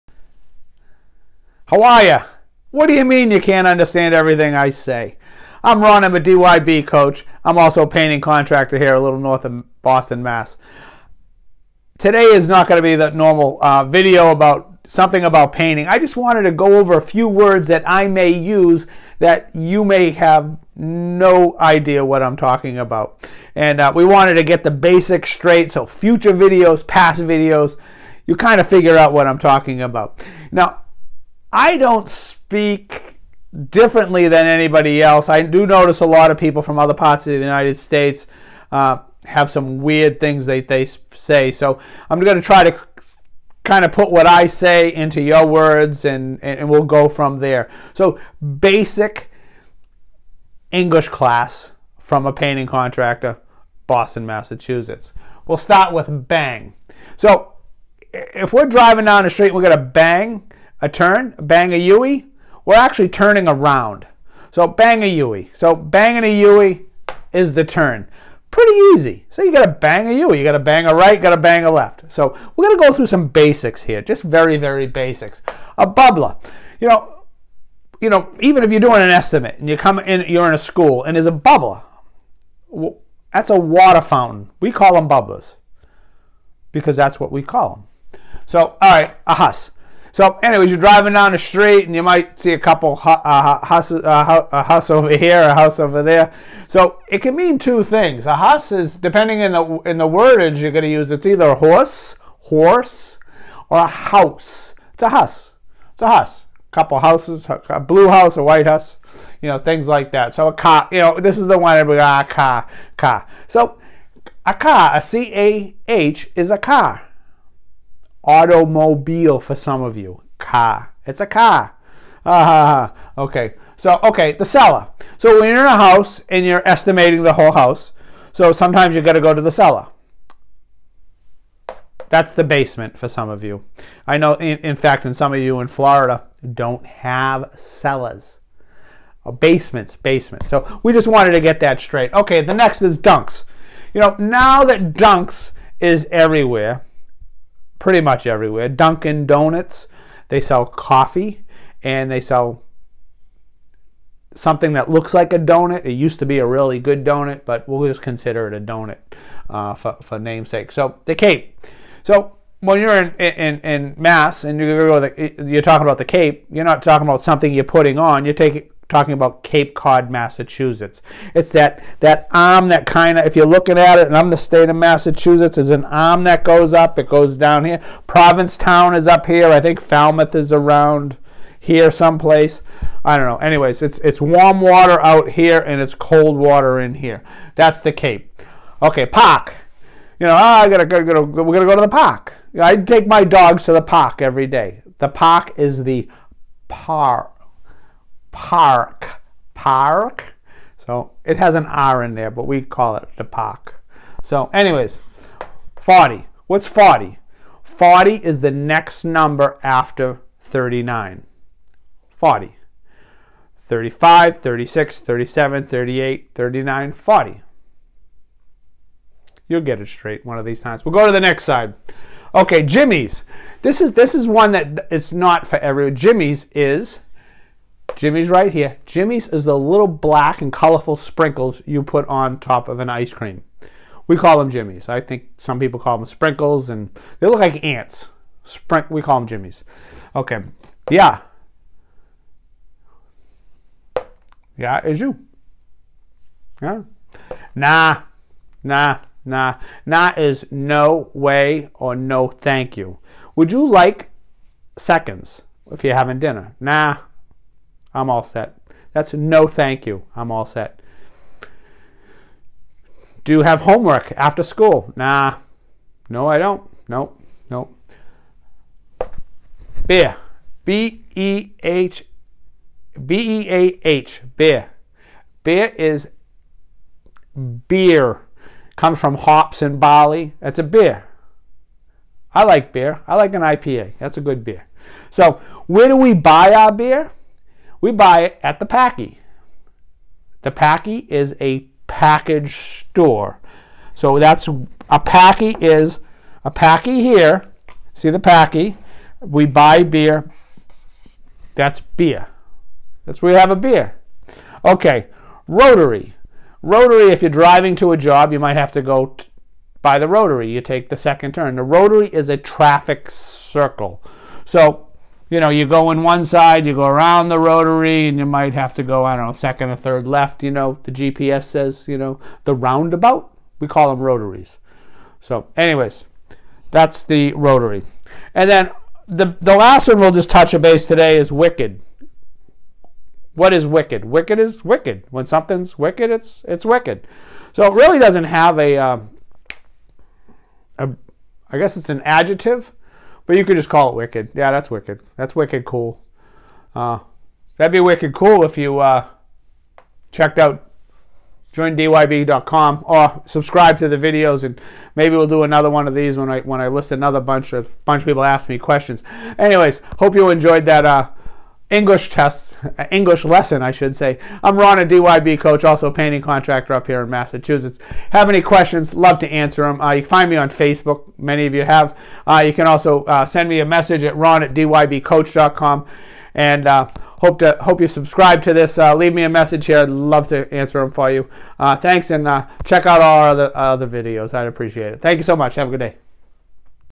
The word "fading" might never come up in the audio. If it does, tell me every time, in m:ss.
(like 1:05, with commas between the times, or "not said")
not said.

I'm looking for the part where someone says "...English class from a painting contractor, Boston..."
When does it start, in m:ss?
0:50.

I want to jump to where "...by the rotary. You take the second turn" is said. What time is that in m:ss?
5:09.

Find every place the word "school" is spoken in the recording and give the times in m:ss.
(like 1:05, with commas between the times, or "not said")
1:20, 4:24.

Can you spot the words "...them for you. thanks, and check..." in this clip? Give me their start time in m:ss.
6:20.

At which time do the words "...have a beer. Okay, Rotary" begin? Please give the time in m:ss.
5:03.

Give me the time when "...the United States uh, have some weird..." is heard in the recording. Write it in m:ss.
0:37.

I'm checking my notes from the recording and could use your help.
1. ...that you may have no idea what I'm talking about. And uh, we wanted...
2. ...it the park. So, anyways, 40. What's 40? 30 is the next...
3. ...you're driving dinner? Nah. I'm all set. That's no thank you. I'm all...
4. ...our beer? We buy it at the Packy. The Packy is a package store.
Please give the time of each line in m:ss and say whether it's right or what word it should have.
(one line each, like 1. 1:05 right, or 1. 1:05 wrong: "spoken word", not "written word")
1. 0:19 right
2. 3:22 wrong: "40", not "30"
3. 4:15 wrong: "having", not "driving"
4. 4:46 right.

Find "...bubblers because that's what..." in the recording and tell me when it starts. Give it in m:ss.
1:25.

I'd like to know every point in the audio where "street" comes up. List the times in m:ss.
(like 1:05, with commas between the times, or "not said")
0:59, 1:31.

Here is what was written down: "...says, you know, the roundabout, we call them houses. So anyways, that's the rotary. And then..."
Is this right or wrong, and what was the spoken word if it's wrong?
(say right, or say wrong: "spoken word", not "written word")
wrong: "rotaries", not "houses".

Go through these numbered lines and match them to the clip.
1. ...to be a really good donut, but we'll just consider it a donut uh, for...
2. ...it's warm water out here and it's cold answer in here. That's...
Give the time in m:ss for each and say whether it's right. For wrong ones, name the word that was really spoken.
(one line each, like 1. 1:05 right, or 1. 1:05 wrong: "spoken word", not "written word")
1. 2:36 right
2. 3:03 wrong: "water", not "answer".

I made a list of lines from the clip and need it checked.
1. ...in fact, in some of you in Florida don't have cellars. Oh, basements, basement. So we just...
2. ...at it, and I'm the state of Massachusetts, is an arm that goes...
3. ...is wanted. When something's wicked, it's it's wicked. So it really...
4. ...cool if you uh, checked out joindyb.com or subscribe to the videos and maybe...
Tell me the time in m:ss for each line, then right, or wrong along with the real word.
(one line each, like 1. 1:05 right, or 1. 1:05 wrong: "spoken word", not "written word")
1. 2:14 right
2. 2:53 right
3. 5:34 wrong: "wicked", not "wanted"
4. 5:48 right.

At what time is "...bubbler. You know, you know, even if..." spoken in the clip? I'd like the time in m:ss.
1:15.